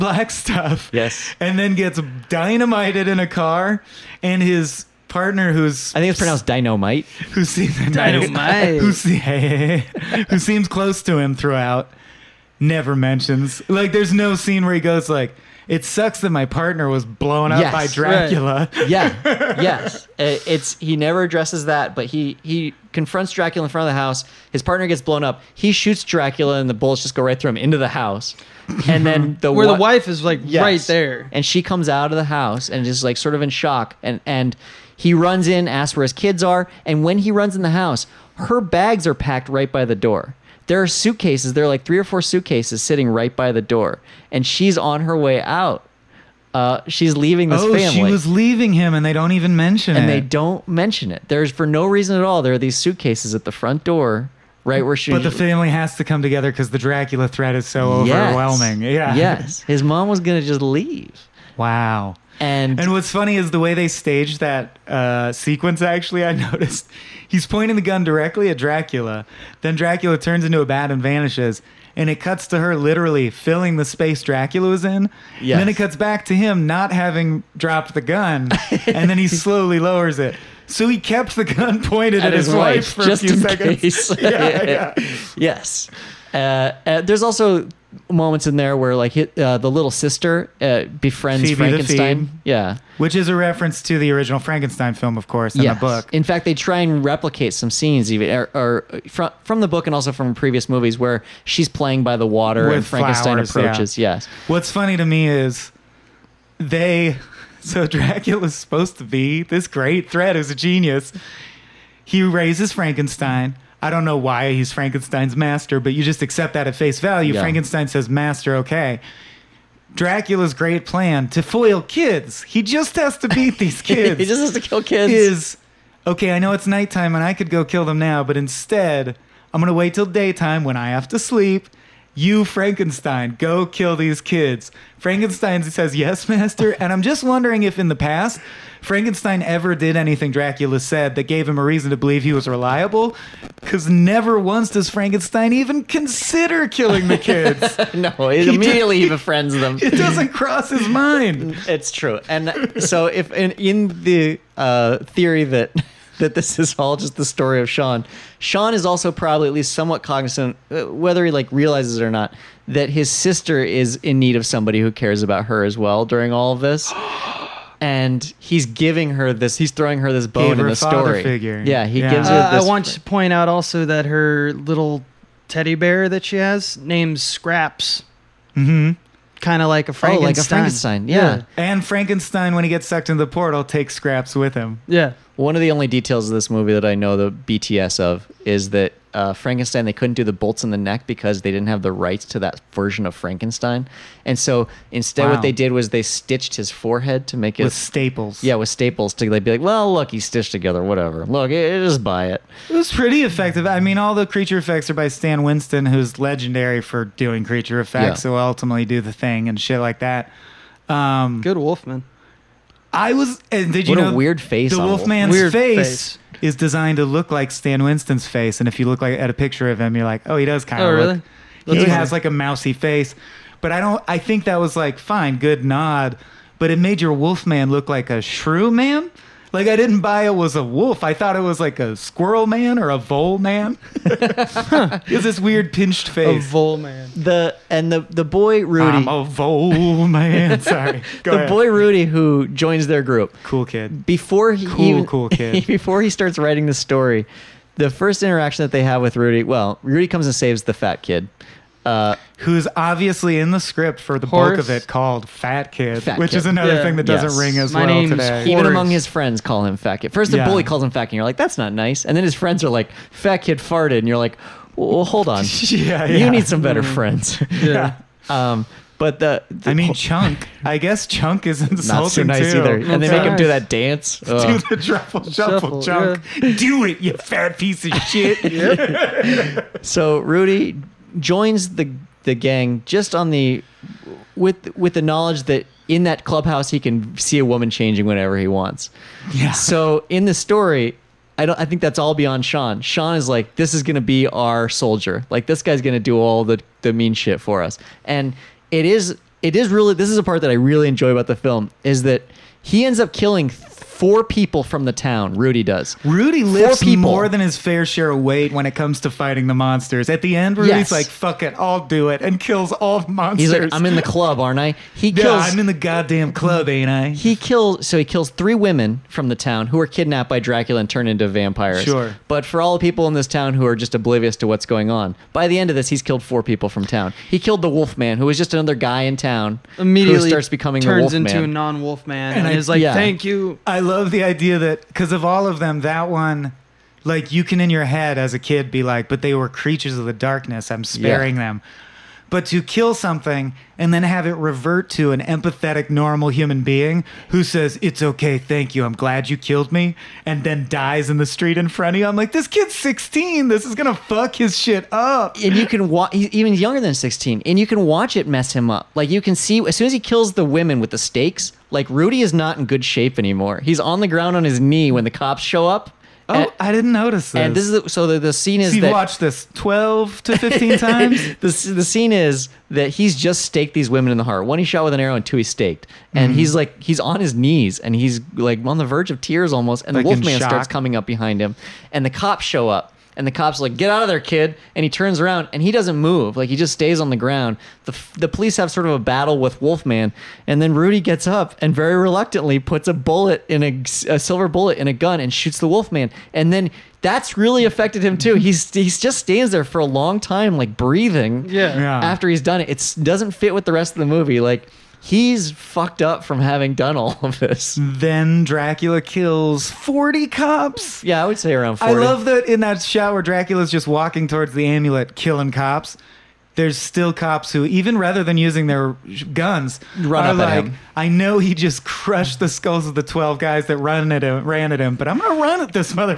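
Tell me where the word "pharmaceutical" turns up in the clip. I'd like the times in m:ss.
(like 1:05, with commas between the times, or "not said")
not said.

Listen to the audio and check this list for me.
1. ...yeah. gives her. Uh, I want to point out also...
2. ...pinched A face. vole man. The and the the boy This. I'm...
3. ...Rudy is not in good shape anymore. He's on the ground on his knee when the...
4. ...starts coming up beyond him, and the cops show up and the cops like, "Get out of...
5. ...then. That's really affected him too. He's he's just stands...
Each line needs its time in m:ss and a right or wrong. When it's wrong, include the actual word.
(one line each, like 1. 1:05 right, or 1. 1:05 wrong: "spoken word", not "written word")
1. 2:51 right
2. 3:55 wrong: "Rudy", not "This"
3. 6:01 right
4. 6:20 wrong: "behind", not "beyond"
5. 6:36 right.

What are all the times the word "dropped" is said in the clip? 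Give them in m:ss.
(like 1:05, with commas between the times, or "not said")
1:17.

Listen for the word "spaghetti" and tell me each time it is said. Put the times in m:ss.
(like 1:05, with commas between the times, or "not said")
not said.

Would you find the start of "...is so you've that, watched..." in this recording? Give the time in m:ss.
6:08.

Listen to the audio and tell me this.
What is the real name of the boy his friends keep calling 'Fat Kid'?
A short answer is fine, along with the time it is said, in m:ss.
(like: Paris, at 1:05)
Horace, at 4:18.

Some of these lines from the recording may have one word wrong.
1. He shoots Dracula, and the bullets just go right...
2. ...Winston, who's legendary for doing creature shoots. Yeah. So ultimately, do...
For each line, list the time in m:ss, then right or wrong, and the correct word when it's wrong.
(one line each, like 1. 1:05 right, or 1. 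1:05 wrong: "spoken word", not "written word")
1. 0:25 right
2. 3:25 wrong: "effects", not "shoots".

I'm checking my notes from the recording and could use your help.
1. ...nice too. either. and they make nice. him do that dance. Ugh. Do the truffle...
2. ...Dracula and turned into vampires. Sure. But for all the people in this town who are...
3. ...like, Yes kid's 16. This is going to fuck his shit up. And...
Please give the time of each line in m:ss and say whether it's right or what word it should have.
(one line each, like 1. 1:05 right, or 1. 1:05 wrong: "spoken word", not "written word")
1. 4:32 right
2. 5:20 right
3. 5:52 wrong: "This", not "Yes".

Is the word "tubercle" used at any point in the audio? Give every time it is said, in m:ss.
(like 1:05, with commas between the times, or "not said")
not said.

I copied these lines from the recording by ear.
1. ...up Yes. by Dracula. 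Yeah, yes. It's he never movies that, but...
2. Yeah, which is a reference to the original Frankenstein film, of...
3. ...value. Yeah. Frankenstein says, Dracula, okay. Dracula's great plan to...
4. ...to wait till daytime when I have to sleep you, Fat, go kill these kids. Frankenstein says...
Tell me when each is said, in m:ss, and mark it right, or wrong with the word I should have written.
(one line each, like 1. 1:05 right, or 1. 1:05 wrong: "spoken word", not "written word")
1. 0:17 wrong: "addresses", not "movies"
2. 1:32 right
3. 1:56 wrong: "Master", not "Dracula"
4. 2:09 wrong: "Frankenstein", not "Fat".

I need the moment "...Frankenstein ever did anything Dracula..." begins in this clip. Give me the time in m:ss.
2:18.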